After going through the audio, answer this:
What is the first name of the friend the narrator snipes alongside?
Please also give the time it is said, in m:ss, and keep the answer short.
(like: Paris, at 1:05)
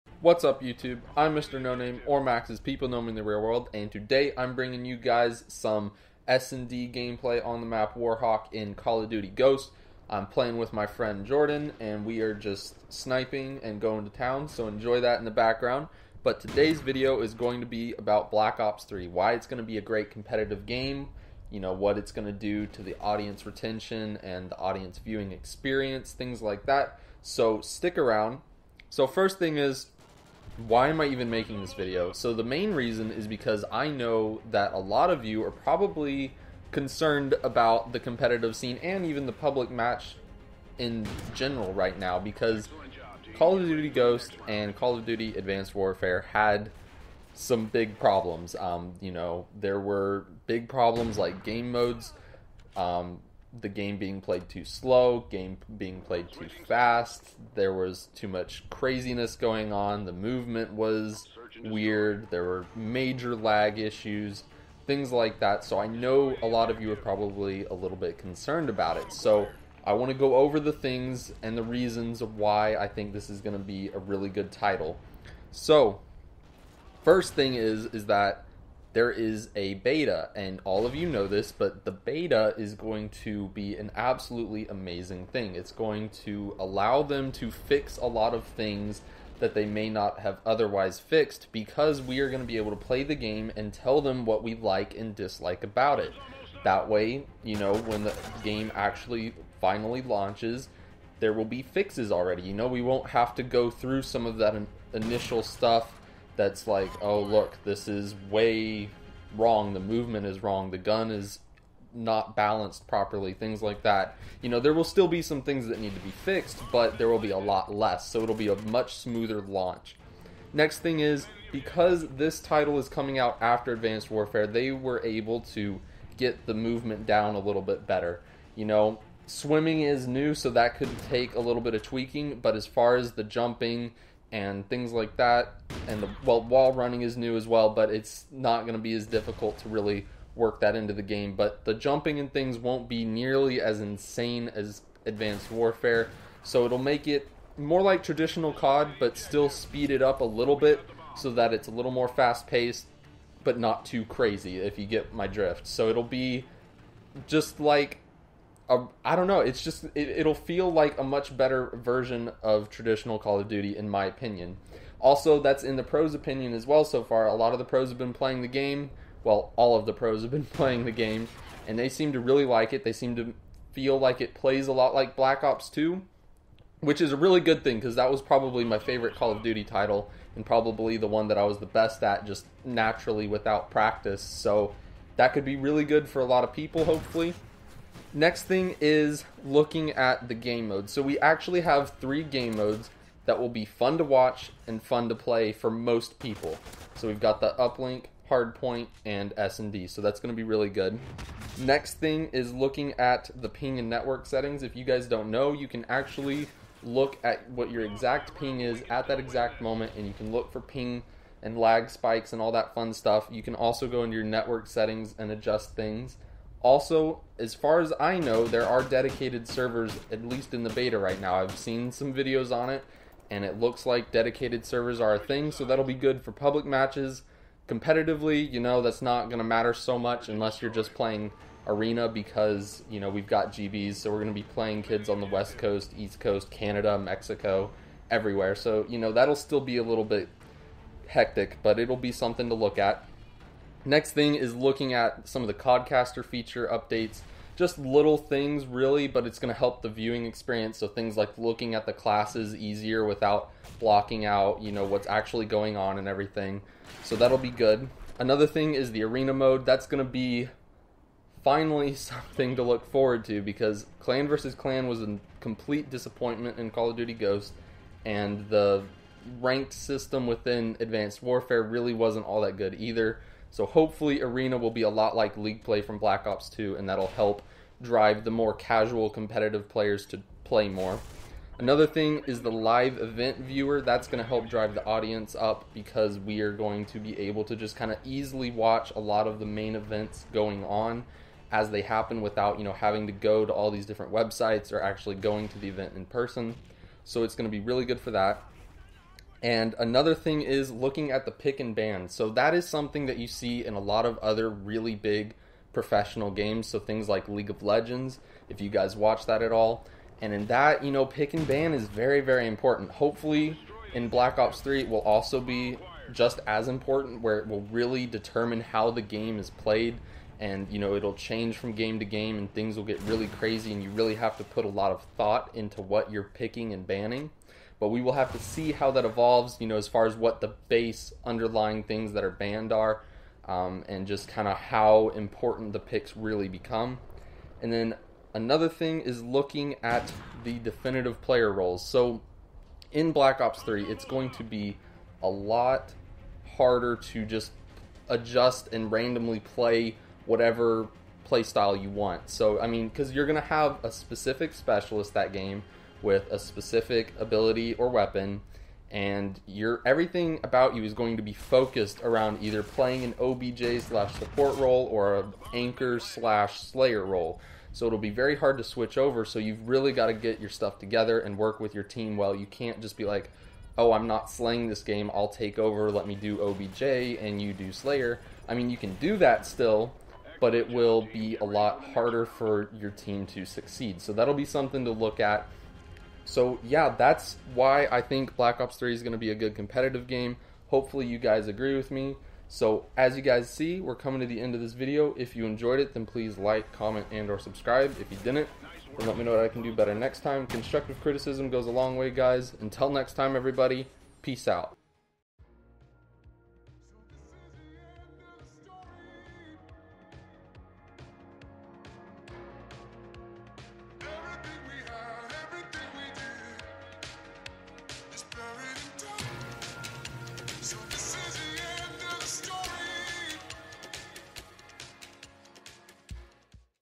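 Jordan, at 0:11.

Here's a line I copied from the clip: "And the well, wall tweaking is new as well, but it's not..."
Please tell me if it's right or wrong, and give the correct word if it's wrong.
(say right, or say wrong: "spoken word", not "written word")
wrong: "running", not "tweaking".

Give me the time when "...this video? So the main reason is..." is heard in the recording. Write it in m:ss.
0:31.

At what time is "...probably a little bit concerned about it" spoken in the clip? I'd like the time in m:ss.
1:06.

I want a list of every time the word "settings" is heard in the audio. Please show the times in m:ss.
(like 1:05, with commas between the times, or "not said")
3:24, 3:34.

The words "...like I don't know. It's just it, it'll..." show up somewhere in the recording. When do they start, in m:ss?
2:37.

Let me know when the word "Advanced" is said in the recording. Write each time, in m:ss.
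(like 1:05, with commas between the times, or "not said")
0:45, 2:03, 2:25, 4:30.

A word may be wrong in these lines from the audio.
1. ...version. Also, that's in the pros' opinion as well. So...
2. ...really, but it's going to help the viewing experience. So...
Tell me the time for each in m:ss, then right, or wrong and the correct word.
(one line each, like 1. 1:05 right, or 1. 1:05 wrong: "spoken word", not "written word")
1. 2:44 wrong: "opinion", not "version"
2. 4:08 right.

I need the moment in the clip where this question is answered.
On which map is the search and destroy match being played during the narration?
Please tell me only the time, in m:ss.
0:07.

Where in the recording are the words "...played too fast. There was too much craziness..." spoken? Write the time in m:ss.
0:56.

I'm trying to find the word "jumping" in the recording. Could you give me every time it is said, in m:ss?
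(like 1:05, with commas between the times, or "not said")
2:13, 2:21.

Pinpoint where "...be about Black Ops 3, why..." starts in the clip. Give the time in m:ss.
0:17.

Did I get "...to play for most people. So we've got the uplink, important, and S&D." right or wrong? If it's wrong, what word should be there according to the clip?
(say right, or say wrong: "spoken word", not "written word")
wrong: "hardpoint", not "important".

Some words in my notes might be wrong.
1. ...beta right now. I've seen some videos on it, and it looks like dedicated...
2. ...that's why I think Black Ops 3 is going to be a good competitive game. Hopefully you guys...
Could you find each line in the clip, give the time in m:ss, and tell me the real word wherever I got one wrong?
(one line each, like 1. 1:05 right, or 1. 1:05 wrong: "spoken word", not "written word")
1. 3:40 right
2. 6:26 right.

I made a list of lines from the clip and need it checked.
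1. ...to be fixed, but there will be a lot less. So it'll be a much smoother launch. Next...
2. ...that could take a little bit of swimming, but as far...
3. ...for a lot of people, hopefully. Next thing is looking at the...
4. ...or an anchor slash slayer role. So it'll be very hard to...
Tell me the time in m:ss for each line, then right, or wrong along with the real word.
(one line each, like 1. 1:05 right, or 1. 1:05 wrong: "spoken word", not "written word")
1. 1:55 right
2. 2:10 wrong: "tweaking", not "swimming"
3. 3:06 right
4. 6:04 right.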